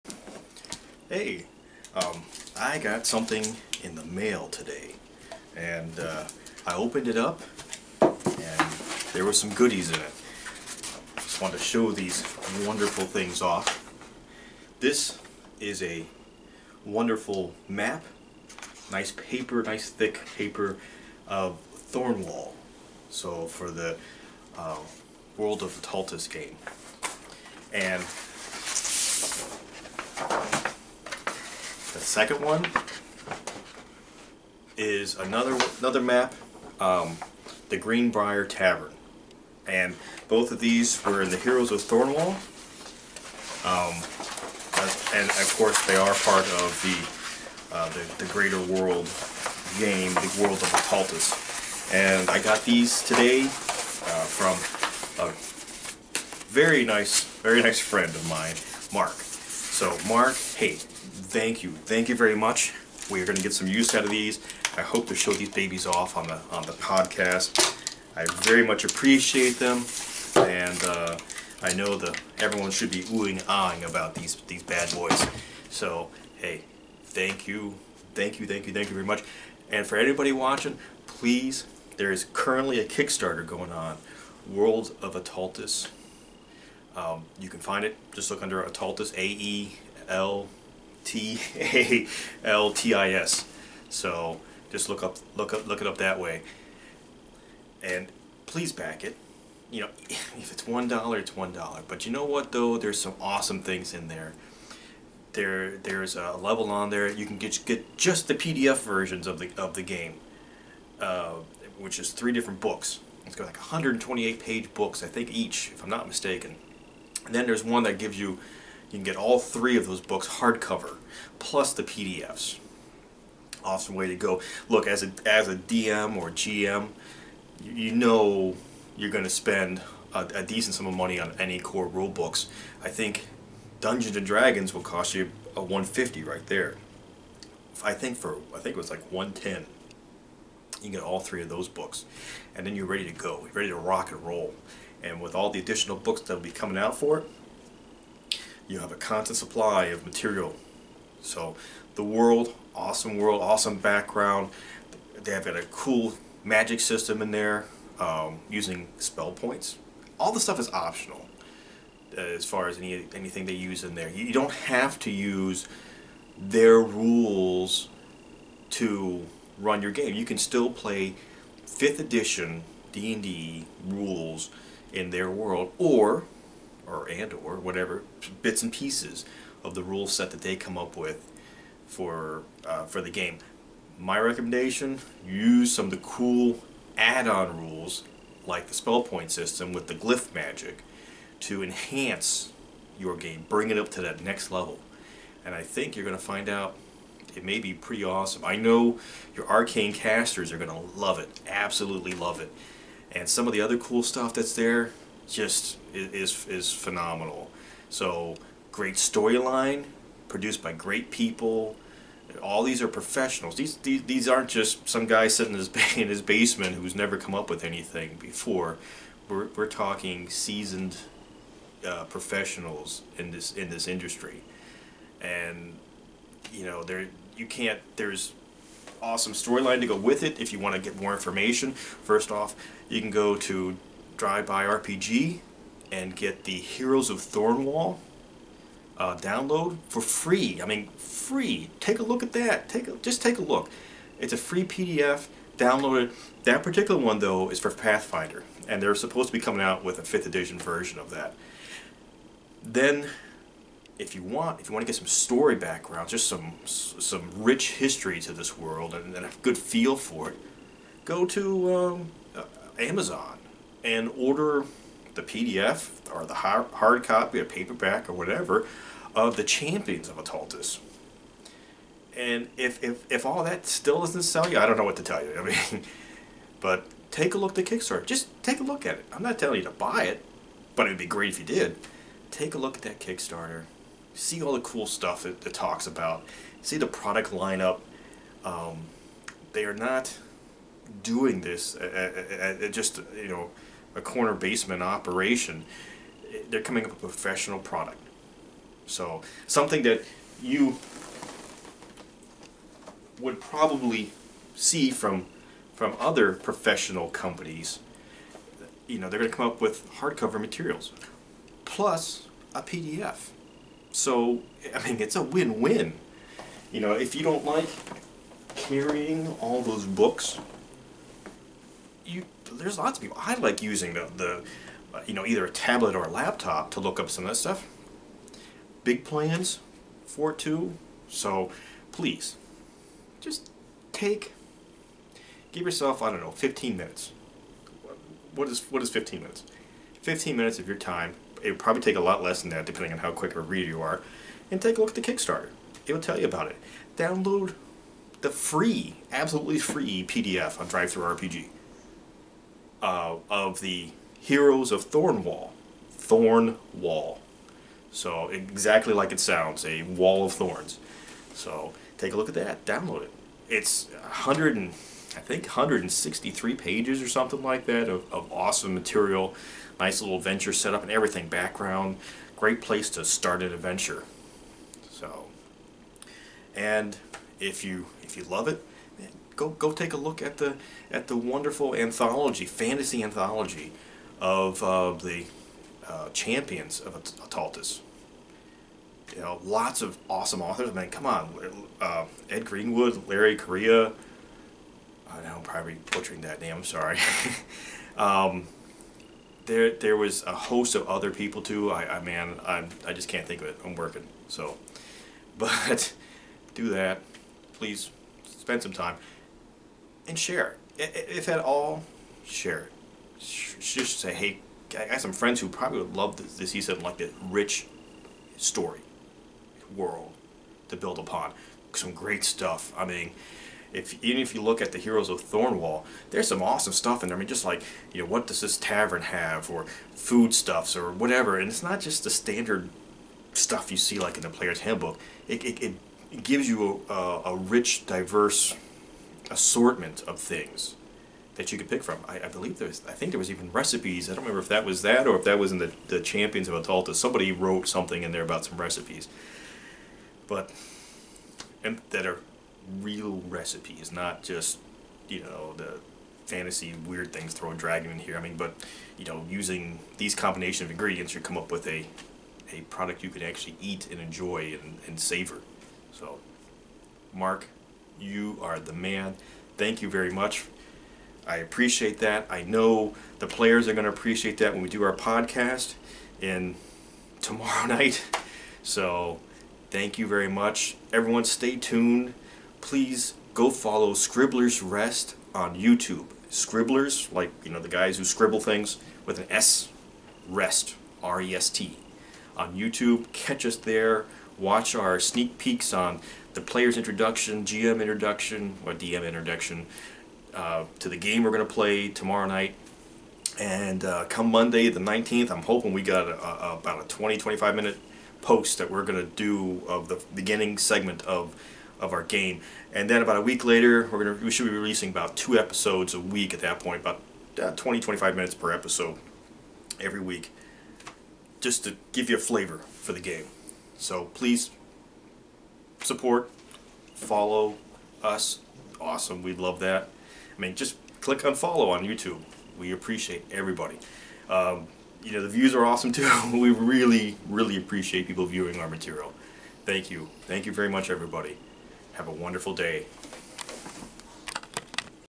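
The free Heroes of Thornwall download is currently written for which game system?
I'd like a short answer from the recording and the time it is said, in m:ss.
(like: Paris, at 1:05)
Pathfinder, at 4:07.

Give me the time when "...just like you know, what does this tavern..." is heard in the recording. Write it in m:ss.
7:07.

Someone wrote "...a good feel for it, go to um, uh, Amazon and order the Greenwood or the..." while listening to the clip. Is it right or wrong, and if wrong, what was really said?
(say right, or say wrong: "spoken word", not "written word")
wrong: "PDF", not "Greenwood".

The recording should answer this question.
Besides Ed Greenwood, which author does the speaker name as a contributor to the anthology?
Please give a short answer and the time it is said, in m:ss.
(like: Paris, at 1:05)
Larry Correia, at 6:33.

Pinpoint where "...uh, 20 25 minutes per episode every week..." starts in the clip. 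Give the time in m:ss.
8:37.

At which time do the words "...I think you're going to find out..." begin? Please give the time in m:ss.
3:15.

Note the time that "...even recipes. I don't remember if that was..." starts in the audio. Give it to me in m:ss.
7:23.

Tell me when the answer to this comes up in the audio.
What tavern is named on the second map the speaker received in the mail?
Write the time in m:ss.
0:37.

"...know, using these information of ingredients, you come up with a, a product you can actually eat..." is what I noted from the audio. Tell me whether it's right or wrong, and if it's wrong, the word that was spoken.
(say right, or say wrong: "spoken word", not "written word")
wrong: "combination", not "information".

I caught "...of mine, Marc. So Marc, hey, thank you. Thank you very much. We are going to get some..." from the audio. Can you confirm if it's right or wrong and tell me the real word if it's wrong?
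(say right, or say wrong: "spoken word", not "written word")
right.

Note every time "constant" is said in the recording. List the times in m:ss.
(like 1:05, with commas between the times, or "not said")
2:28.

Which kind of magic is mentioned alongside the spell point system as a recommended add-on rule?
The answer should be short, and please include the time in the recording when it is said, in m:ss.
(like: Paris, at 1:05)
glyph magic, at 3:09.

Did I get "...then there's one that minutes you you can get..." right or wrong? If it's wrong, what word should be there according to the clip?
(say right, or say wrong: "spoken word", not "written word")
wrong: "gives", not "minutes".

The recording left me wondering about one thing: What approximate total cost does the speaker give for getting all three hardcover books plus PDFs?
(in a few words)
110.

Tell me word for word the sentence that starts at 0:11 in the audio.
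just wanted to show these wonderful things off.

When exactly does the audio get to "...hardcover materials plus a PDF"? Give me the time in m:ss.
5:09.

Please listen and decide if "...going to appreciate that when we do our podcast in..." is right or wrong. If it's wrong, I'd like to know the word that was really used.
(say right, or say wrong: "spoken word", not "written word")
right.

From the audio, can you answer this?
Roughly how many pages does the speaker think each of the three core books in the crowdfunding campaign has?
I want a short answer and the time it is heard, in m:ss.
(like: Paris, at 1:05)
128, at 1:53.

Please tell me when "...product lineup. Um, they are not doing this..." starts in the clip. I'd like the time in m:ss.
4:46.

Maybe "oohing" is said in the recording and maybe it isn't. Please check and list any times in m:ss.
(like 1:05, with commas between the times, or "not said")
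1:13.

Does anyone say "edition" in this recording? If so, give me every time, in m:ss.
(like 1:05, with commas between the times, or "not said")
2:51, 4:10.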